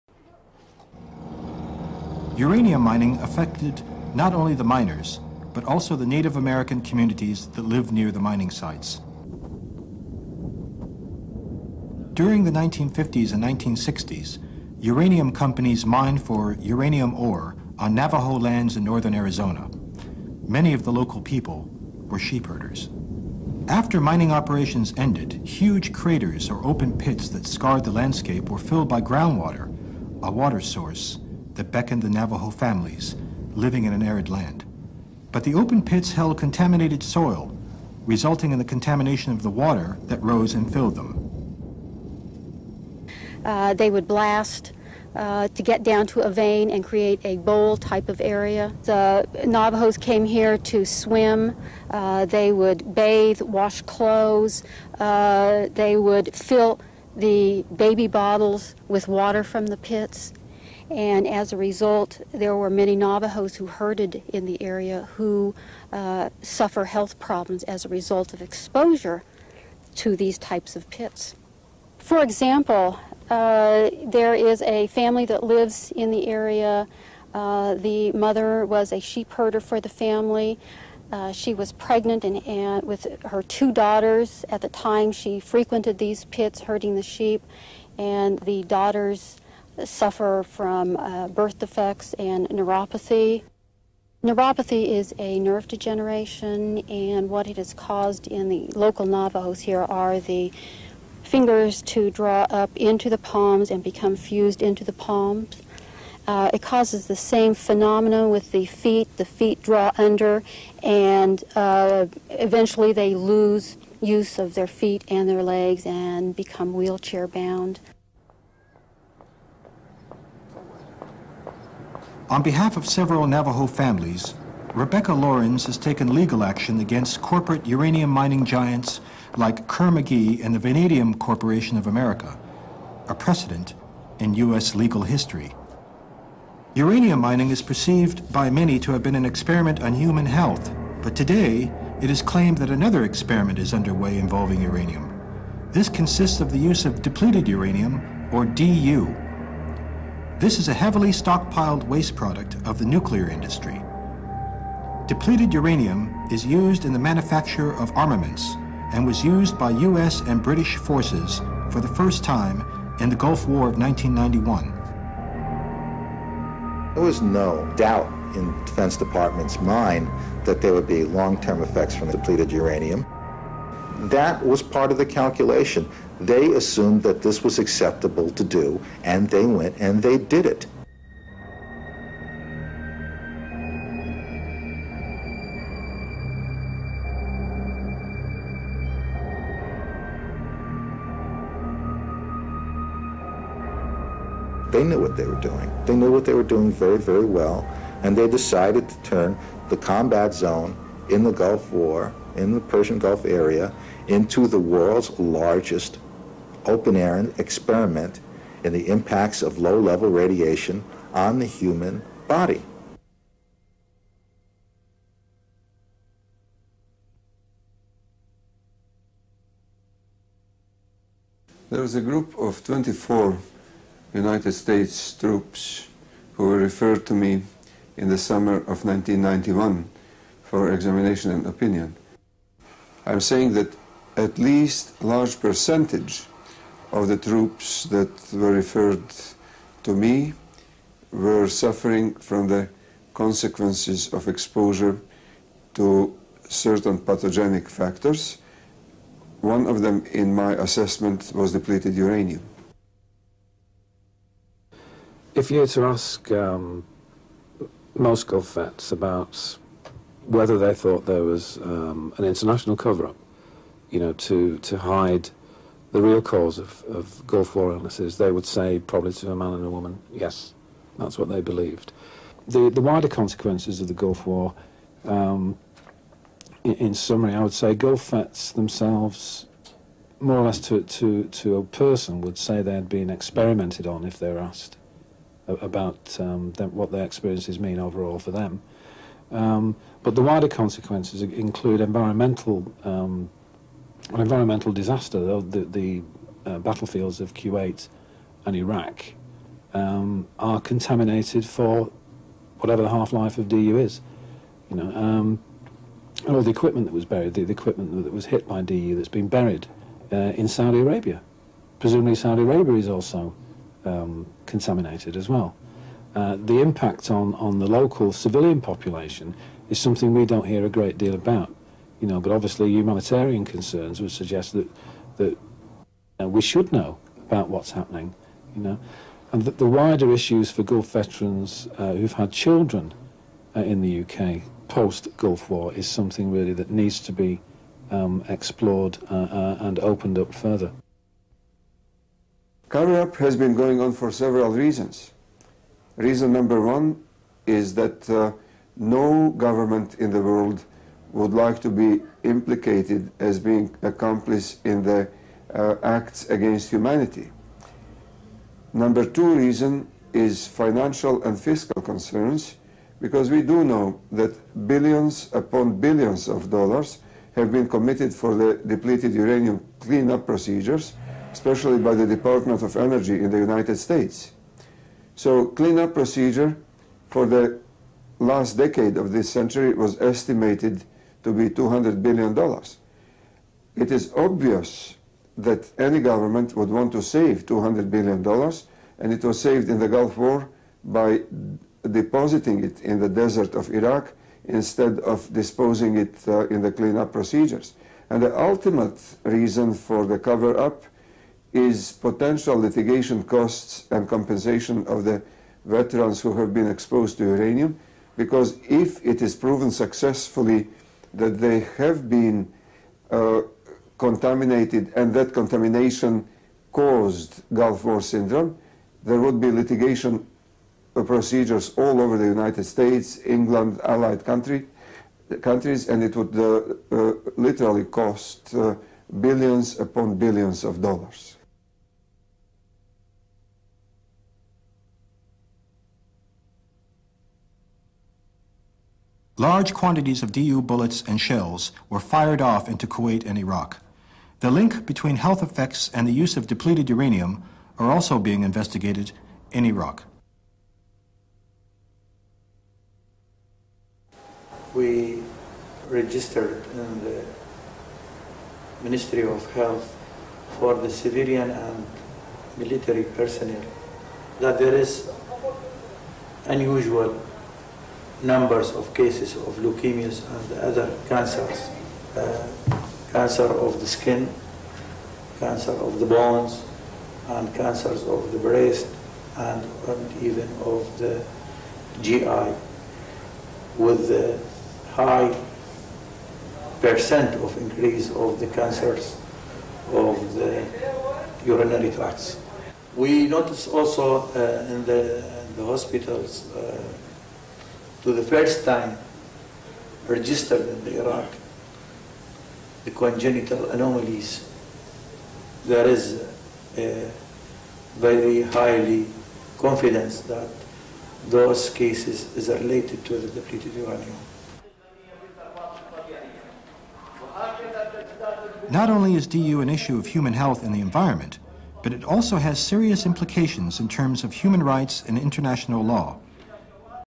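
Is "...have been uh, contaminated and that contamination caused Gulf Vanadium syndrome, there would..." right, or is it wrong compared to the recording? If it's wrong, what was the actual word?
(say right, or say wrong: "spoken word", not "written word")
wrong: "War", not "Vanadium".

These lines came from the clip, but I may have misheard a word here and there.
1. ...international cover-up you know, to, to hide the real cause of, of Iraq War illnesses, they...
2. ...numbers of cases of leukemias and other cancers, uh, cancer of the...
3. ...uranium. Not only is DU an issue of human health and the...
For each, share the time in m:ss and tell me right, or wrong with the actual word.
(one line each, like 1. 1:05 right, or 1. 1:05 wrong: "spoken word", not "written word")
1. 4:22 wrong: "Gulf", not "Iraq"
2. 7:48 right
3. 8:33 right.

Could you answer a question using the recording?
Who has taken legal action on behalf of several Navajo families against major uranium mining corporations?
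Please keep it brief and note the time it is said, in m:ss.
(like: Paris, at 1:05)
Rebecca Lawrence, at 2:04.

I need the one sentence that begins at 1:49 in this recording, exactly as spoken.
The feet draw under, and uh, eventually they lose use of their feet and their legs and become wheelchair bound.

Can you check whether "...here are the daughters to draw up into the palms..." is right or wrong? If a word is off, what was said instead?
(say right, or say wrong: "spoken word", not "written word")
wrong: "fingers", not "daughters".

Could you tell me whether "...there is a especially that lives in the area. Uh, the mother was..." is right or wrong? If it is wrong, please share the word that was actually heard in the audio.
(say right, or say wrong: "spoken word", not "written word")
wrong: "family", not "especially".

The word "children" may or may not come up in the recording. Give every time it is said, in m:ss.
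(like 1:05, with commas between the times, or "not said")
5:32.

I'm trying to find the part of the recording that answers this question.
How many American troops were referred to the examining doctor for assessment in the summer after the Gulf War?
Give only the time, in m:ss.
3:42.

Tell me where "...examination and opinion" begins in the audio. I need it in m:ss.
3:50.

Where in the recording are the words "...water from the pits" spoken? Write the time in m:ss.
0:59.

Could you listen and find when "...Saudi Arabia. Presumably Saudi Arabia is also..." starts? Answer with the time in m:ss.
5:10.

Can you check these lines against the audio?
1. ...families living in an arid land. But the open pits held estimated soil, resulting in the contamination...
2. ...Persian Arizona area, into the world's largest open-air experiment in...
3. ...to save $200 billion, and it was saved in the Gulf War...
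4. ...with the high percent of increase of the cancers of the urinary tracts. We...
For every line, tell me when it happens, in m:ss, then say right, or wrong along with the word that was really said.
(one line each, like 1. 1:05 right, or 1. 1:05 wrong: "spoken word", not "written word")
1. 0:32 wrong: "contaminated", not "estimated"
2. 3:22 wrong: "Gulf", not "Arizona"
3. 6:26 right
4. 8:03 right.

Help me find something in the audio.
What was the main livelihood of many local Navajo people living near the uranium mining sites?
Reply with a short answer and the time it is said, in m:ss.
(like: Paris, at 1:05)
Sheep herders, at 0:22.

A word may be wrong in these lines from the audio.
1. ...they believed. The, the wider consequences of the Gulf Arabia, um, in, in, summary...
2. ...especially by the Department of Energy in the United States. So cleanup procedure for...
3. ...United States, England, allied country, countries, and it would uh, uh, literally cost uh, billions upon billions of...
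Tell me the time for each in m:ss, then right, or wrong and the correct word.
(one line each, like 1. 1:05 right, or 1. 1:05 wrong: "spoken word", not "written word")
1. 4:31 wrong: "War", not "Arabia"
2. 6:11 right
3. 7:02 right.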